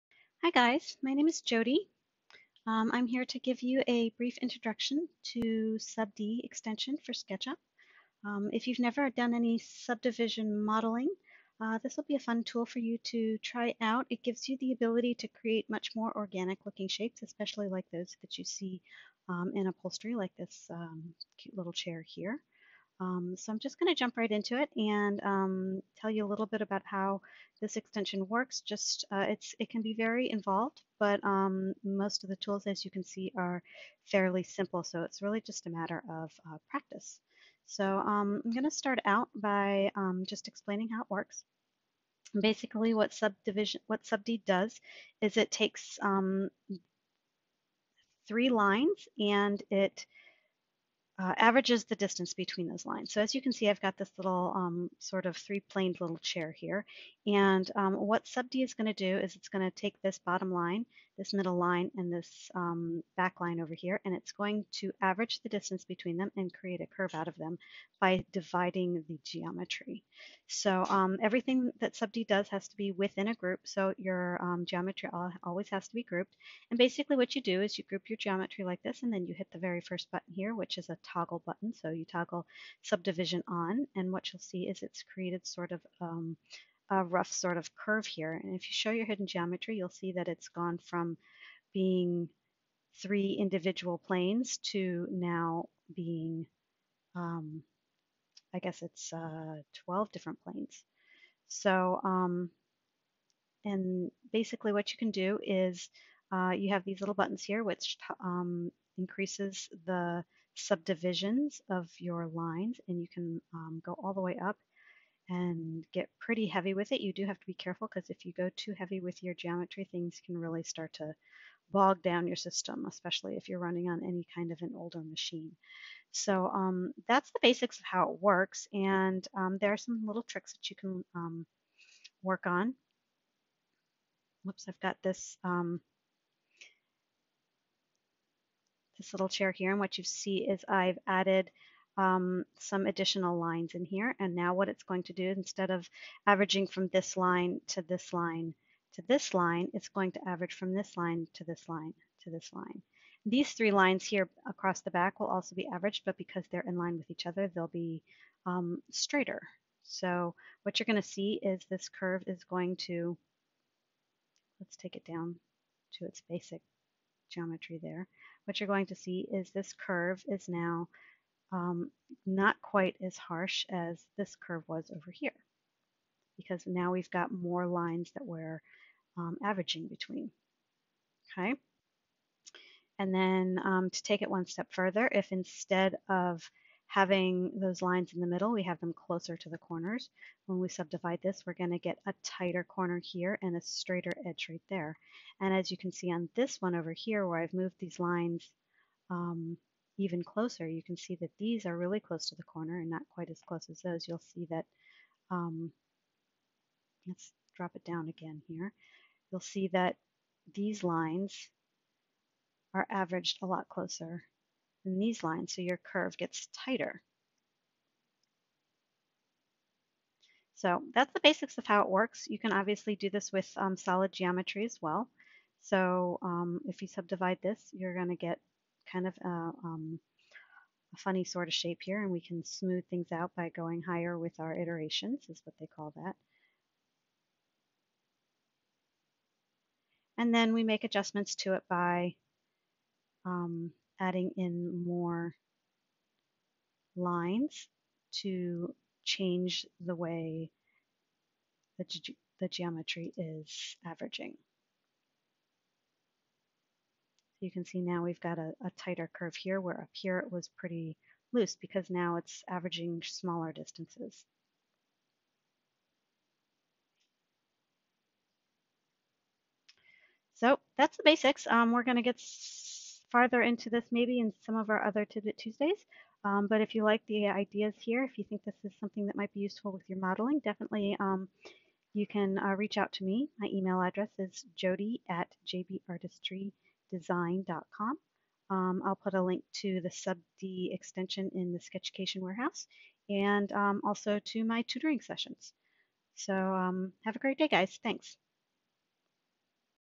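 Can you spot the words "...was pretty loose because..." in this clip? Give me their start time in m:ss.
4:20.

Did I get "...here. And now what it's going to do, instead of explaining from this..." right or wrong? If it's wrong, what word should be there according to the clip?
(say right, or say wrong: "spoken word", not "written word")
wrong: "averaging", not "explaining".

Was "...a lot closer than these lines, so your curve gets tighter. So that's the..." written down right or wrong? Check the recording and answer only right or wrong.
right.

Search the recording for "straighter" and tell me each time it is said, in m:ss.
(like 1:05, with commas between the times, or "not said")
2:38, 3:13.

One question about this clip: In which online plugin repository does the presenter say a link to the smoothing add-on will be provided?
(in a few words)
SketchUcation Warehouse.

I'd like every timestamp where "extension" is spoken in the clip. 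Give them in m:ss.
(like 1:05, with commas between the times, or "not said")
0:06, 0:27, 4:50.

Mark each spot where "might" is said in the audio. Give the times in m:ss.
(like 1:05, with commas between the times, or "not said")
4:39.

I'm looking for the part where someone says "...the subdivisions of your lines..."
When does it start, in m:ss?
1:49.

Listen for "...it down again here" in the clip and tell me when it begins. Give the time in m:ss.
3:27.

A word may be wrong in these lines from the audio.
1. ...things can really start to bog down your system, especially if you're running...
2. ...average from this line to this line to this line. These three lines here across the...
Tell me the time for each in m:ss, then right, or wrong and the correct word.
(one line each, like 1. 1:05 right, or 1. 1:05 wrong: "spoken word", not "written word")
1. 1:59 right
2. 2:30 right.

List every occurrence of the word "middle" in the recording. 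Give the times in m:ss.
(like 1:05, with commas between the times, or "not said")
1:01, 3:08.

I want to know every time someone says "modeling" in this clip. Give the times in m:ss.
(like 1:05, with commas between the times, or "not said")
0:10, 4:39.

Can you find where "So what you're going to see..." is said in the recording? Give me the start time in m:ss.
2:39.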